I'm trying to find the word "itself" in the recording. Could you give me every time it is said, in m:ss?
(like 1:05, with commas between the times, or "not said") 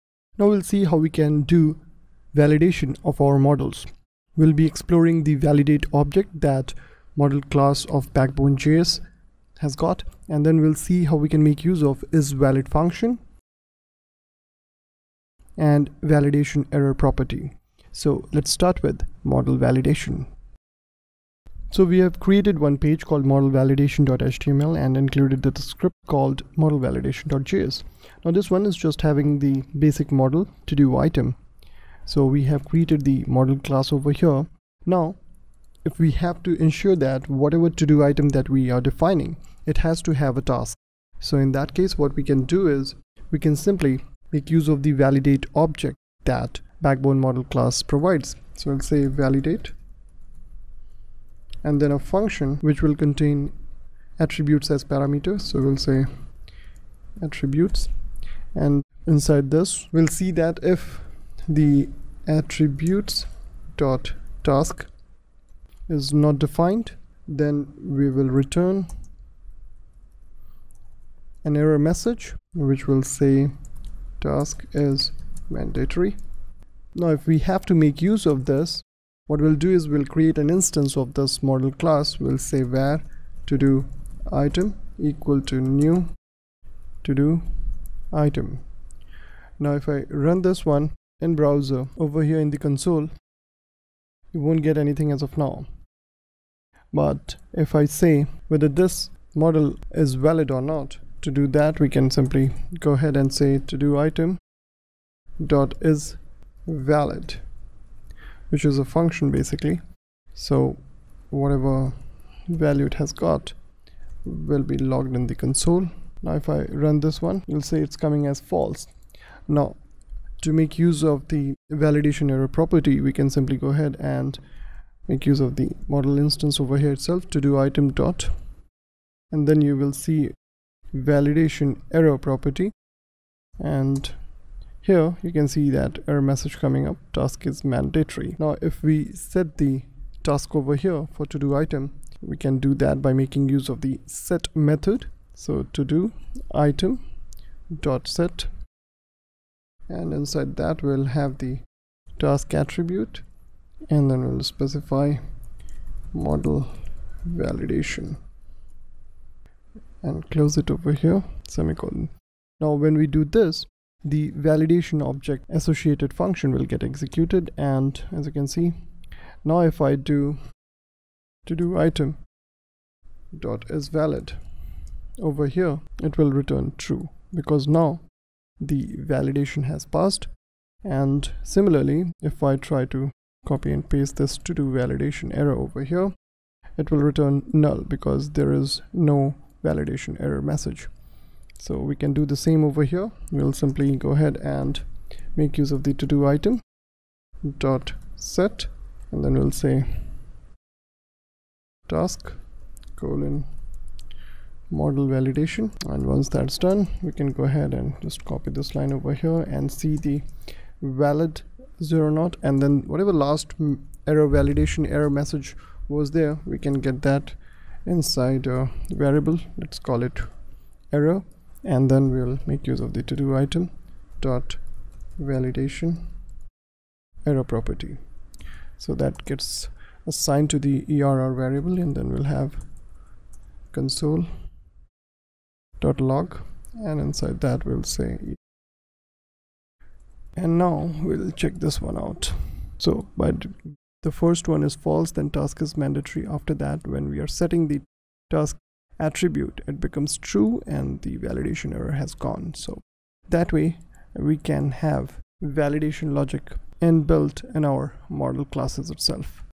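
2:06, 4:18.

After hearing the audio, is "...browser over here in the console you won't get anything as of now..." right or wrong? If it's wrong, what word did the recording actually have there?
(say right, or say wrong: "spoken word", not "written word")
right.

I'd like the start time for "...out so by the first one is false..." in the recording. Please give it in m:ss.
4:01.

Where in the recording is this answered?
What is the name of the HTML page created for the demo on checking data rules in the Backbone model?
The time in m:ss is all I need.
0:23.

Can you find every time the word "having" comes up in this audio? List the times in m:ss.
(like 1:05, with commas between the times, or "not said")
0:29.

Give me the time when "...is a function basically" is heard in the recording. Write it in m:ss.
1:48.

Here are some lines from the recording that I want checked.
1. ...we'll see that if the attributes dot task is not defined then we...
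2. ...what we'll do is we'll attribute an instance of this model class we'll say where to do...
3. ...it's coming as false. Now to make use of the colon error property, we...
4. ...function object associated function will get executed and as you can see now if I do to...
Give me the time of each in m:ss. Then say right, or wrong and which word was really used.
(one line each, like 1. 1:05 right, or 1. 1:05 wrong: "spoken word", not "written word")
1. 0:59 right
2. 1:19 wrong: "create", not "attribute"
3. 1:57 wrong: "validation", not "colon"
4. 2:44 wrong: "validation", not "function".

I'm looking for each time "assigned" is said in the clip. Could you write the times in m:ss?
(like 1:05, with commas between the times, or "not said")
3:50.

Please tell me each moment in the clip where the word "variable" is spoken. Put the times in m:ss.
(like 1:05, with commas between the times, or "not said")
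3:39, 3:51.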